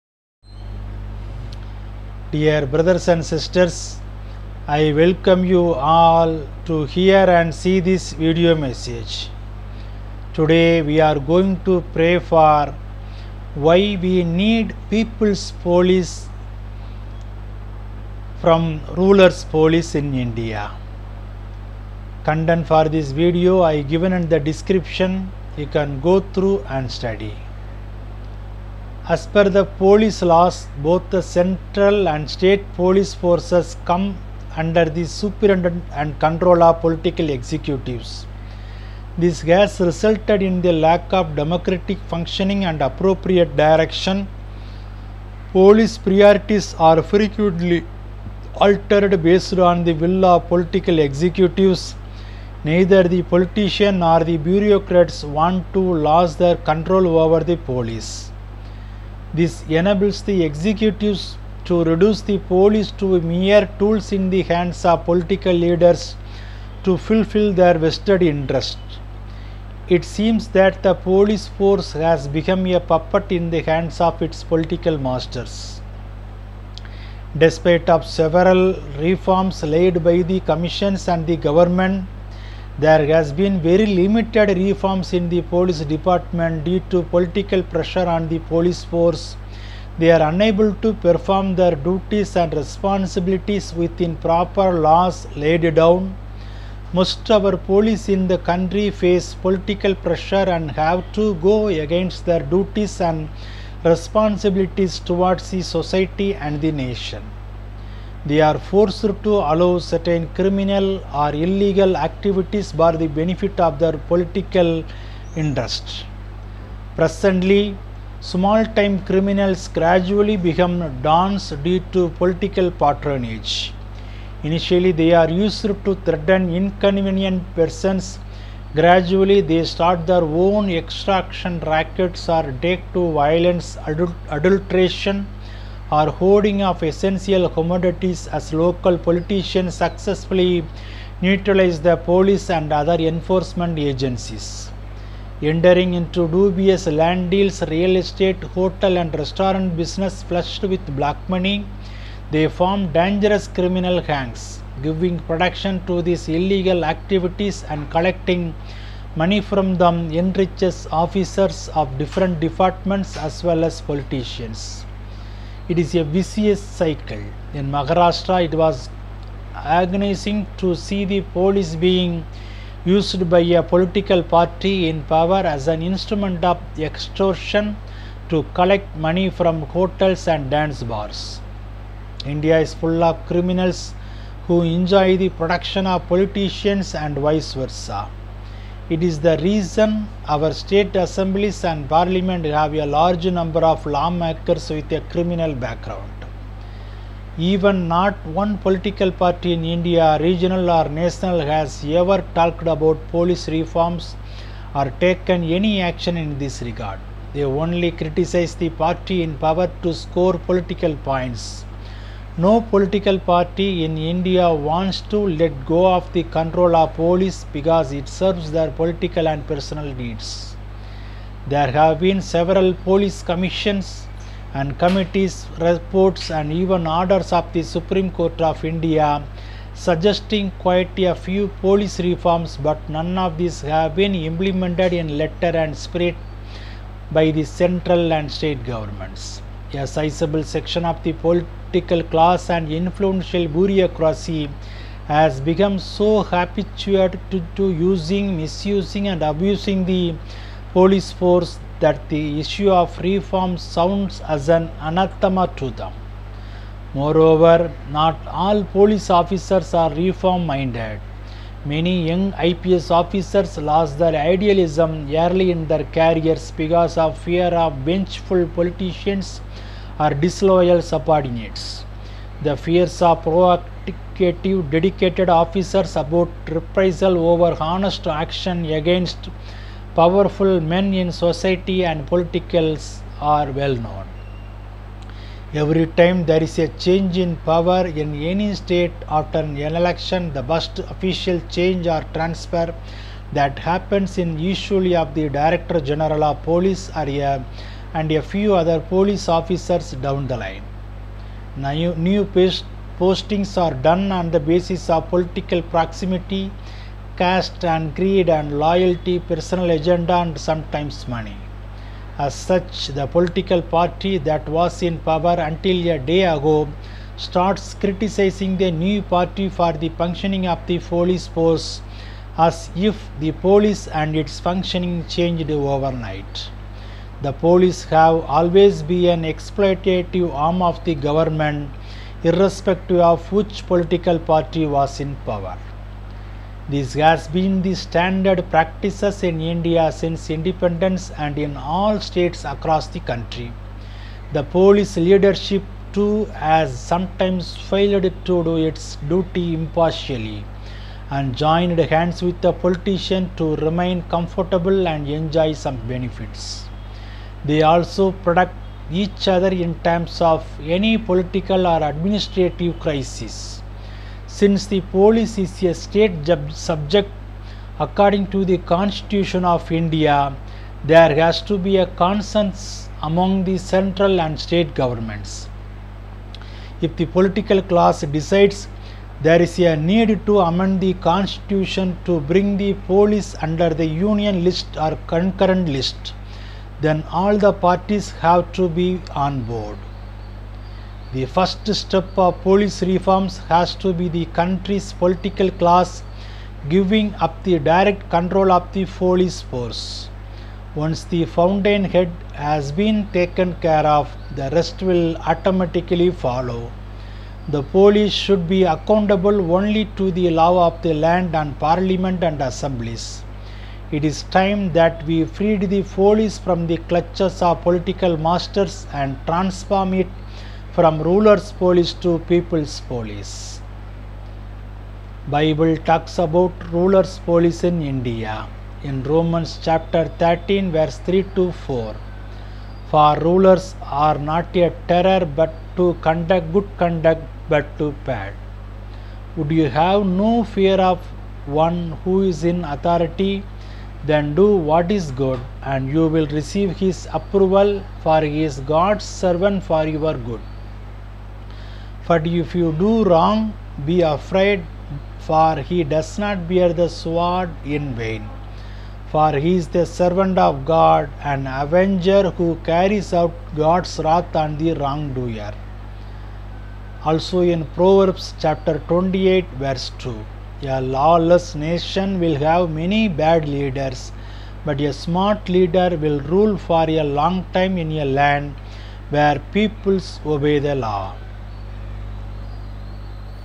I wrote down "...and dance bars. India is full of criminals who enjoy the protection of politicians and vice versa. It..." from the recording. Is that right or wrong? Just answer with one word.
right.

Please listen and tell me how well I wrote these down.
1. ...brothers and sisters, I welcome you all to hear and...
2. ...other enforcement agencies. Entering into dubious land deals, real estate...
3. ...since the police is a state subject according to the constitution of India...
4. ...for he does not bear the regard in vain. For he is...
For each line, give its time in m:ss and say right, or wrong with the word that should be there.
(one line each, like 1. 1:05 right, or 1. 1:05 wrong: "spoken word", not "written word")
1. 0:02 right
2. 2:22 right
3. 6:04 right
4. 7:35 wrong: "sword", not "regard".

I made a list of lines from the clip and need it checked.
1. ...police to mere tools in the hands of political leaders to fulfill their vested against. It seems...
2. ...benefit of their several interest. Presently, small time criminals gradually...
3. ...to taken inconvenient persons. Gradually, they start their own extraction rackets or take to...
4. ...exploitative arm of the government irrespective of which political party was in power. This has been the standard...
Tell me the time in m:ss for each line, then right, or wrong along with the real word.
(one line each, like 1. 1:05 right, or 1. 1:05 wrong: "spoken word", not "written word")
1. 1:02 wrong: "interest", not "against"
2. 1:53 wrong: "political", not "several"
3. 2:05 wrong: "threaten", not "taken"
4. 5:29 right.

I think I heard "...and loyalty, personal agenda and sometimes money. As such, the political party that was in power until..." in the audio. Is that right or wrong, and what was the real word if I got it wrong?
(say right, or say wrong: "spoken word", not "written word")
right.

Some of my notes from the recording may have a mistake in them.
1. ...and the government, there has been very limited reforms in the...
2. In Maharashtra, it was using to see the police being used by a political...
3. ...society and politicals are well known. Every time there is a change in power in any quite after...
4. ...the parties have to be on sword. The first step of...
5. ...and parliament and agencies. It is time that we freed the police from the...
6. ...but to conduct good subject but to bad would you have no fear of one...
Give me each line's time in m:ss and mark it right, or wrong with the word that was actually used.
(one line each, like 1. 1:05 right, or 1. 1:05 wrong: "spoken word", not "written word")
1. 1:21 right
2. 2:47 wrong: "agonizing", not "using"
3. 4:41 wrong: "state", not "quite"
4. 6:27 wrong: "board", not "sword"
5. 6:51 wrong: "assemblies", not "agencies"
6. 7:15 wrong: "conduct", not "subject".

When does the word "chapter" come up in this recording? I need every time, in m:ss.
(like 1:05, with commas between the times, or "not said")
7:09, 7:48.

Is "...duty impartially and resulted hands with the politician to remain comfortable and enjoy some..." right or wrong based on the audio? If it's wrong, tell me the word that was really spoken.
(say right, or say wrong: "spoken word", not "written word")
wrong: "joined", not "resulted".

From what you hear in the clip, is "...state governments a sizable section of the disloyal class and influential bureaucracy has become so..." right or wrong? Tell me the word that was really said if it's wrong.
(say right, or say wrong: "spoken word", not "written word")
wrong: "political", not "disloyal".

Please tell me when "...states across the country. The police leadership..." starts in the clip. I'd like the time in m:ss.
5:41.